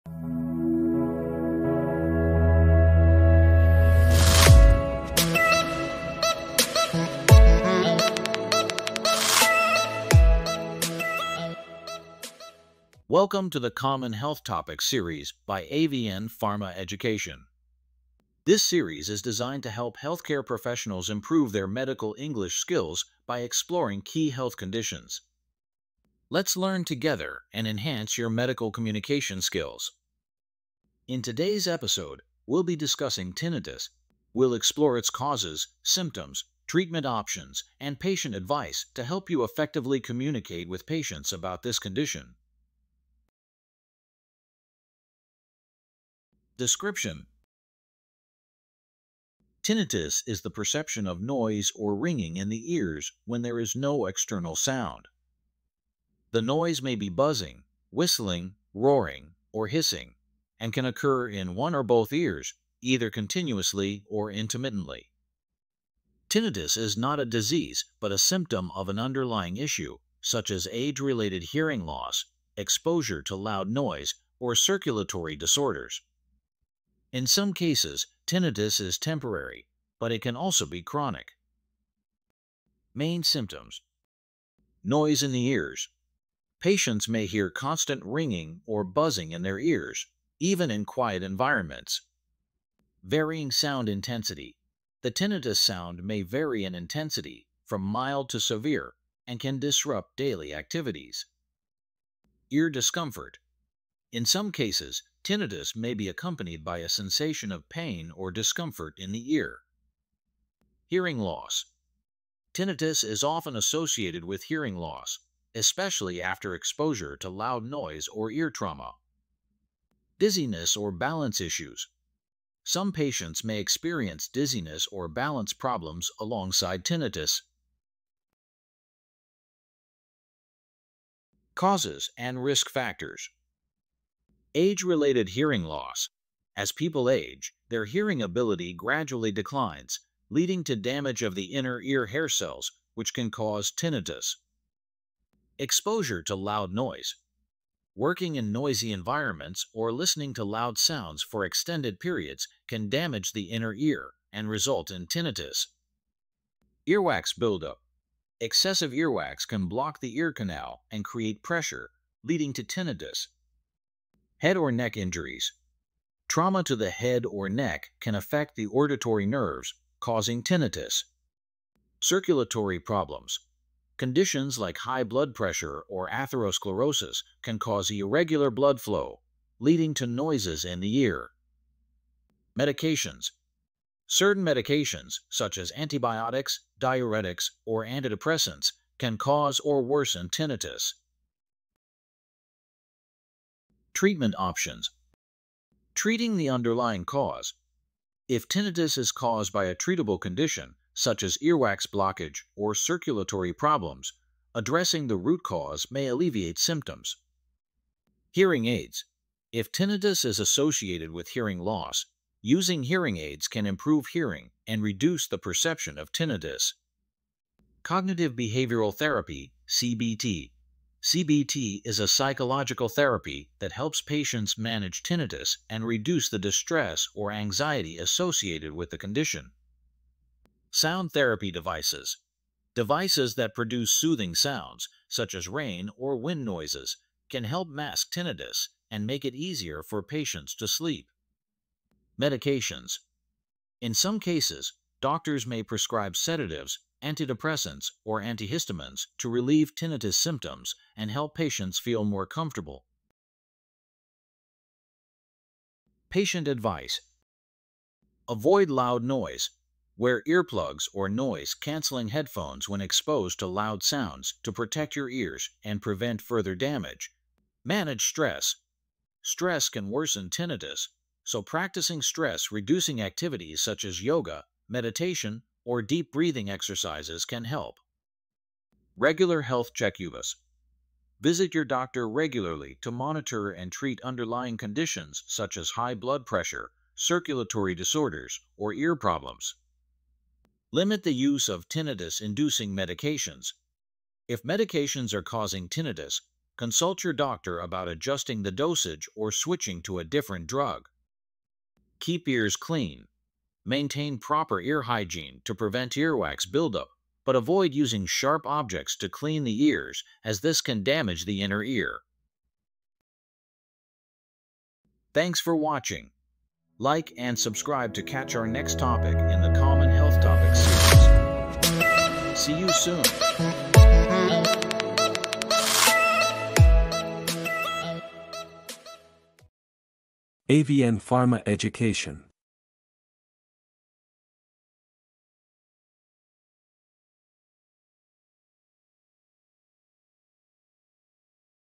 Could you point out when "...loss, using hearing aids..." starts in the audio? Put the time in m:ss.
3:31.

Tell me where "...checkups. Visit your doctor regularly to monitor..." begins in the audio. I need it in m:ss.
4:39.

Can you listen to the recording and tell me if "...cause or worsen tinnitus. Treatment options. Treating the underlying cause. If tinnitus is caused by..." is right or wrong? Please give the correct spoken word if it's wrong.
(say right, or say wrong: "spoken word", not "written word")
right.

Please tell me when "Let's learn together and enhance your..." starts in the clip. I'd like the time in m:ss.
0:26.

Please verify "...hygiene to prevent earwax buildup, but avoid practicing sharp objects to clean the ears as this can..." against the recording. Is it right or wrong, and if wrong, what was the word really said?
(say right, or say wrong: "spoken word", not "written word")
wrong: "using", not "practicing".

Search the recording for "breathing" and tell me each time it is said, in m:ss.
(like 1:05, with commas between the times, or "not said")
4:36.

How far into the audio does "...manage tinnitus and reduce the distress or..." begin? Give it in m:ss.
3:44.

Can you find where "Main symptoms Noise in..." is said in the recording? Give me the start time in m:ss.
1:22.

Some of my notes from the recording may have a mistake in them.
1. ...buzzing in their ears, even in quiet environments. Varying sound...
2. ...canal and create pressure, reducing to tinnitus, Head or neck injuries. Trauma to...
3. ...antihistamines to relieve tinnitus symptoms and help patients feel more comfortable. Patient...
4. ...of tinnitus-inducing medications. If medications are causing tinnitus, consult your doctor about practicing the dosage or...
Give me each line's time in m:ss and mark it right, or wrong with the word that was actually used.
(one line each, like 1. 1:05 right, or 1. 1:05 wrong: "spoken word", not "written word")
1. 1:28 right
2. 2:40 wrong: "leading", not "reducing"
3. 4:08 right
4. 4:51 wrong: "adjusting", not "practicing".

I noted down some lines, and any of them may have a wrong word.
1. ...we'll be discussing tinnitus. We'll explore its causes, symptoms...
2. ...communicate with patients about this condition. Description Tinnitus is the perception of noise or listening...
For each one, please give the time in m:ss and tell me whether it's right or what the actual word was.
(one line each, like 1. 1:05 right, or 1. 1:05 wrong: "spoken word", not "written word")
1. 0:32 right
2. 0:39 wrong: "ringing", not "listening".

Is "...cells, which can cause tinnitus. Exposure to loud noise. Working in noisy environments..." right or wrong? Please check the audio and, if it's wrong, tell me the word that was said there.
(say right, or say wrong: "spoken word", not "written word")
right.